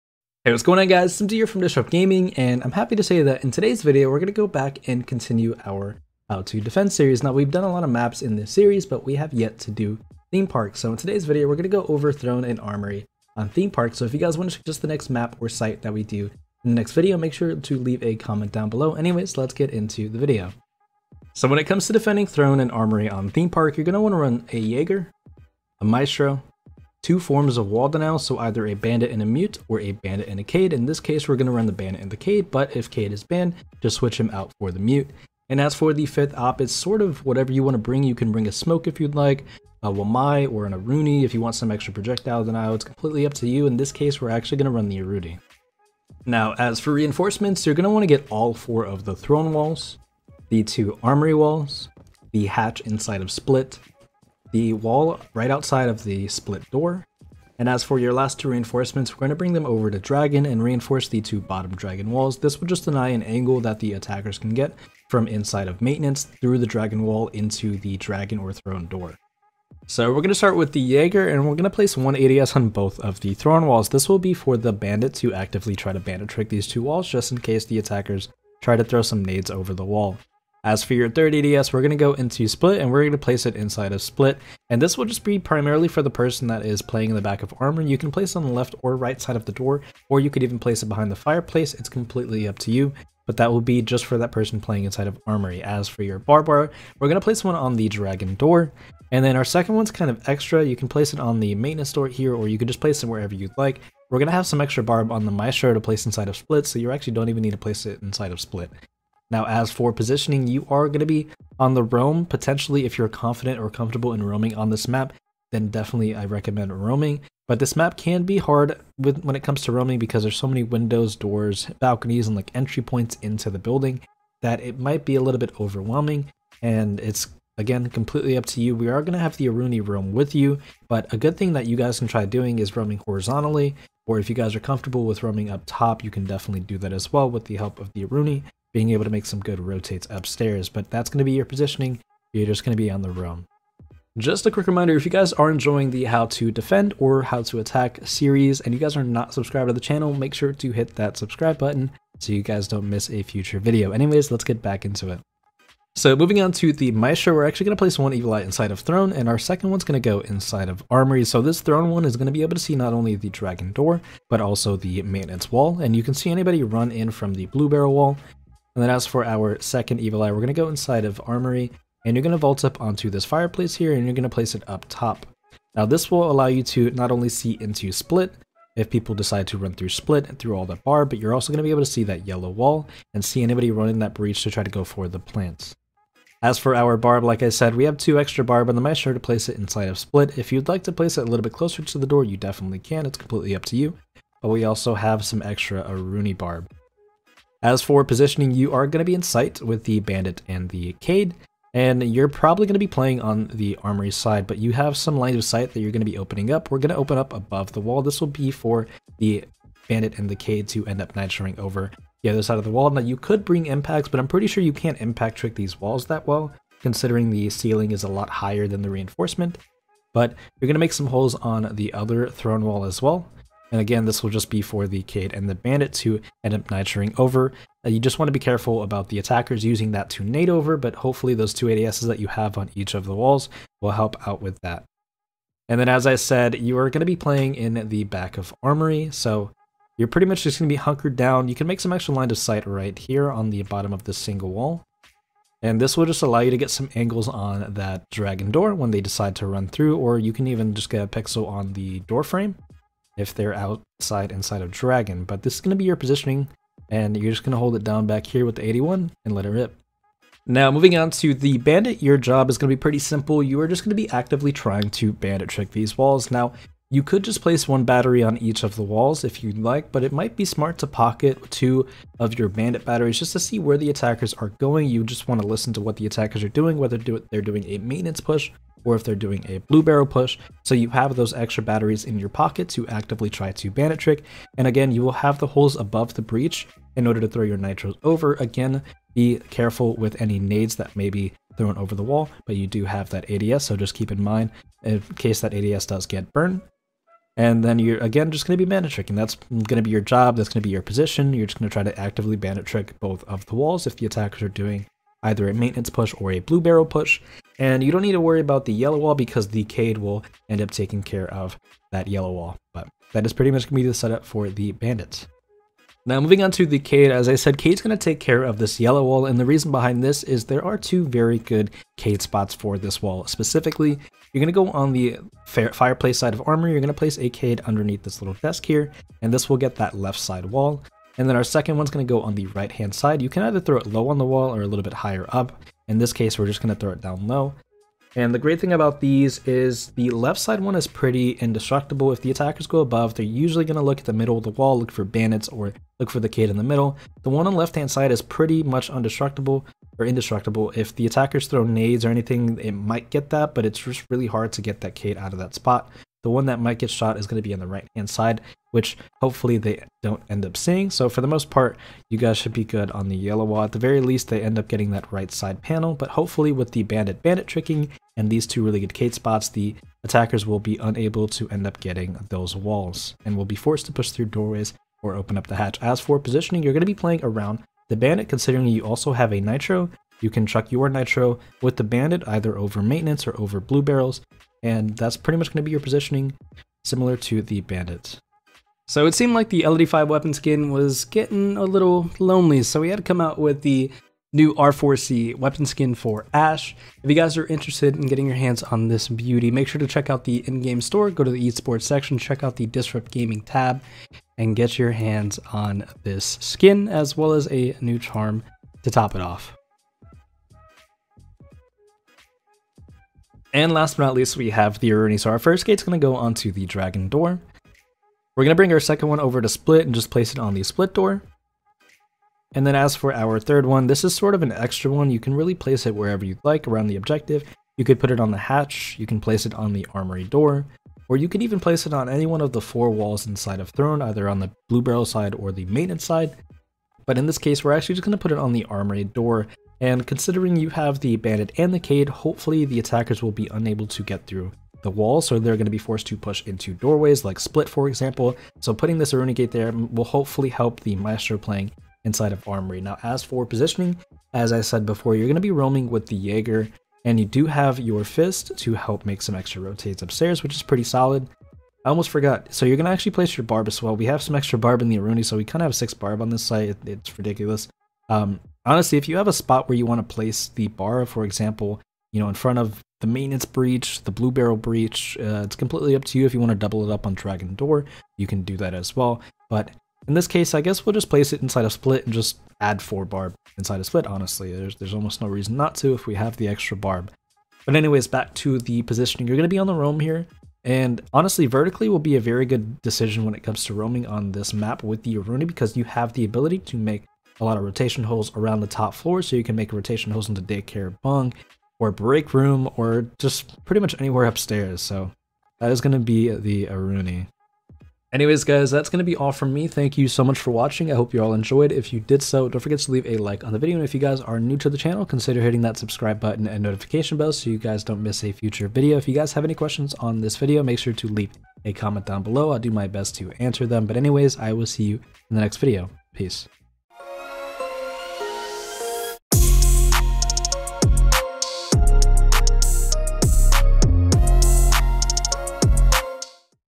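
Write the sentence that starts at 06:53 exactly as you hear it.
And last but not least, we have the Aruni.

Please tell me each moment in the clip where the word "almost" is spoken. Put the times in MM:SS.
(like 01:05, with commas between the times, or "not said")
07:41, 08:04.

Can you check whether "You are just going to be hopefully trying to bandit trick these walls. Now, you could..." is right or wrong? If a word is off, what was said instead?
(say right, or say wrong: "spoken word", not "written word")
wrong: "actively", not "hopefully".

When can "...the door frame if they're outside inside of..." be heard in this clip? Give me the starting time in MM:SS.
04:11.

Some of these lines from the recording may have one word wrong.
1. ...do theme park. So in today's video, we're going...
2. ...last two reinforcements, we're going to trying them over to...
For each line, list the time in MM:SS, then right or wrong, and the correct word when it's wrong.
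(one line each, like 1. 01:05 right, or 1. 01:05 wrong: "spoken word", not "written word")
1. 00:09 right
2. 00:58 wrong: "bring", not "trying".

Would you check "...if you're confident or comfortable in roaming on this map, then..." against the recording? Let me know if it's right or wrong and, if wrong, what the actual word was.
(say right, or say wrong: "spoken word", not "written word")
right.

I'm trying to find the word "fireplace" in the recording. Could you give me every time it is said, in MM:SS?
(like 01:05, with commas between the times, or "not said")
01:31, 02:53, 05:25.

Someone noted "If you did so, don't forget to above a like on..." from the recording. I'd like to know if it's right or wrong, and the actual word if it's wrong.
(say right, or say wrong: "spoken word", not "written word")
wrong: "leave", not "above".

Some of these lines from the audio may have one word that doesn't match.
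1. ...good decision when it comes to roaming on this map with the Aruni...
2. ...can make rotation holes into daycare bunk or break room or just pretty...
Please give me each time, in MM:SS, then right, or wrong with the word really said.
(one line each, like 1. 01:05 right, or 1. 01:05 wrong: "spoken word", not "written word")
1. 08:12 right
2. 08:19 right.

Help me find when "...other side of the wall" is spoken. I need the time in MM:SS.
03:32.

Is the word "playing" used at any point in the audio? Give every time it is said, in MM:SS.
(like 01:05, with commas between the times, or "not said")
01:26, 01:34, 03:22, 03:57, 06:16, 07:31.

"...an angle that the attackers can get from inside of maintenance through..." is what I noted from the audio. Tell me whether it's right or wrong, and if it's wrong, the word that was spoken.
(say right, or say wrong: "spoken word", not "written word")
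right.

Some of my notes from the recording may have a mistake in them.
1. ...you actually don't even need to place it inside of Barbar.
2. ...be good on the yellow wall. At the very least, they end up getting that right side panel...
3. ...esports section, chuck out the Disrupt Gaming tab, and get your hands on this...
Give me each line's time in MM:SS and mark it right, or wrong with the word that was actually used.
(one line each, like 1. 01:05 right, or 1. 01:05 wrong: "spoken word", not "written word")
1. 01:46 wrong: "Split", not "Barbar"
2. 06:02 right
3. 06:41 wrong: "check", not "chuck".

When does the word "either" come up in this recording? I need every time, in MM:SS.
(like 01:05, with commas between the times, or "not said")
00:28, 05:05, 05:33, 06:22, 07:14.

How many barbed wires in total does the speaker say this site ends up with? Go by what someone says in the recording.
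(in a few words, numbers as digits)
6.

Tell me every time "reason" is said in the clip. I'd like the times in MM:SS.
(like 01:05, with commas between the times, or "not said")
05:19, 08:05.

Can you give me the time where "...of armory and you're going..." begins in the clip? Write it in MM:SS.
02:51.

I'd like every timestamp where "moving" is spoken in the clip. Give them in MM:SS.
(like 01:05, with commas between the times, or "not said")
02:36, 04:20, 05:16.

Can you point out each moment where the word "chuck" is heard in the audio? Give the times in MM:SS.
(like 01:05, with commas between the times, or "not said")
06:20.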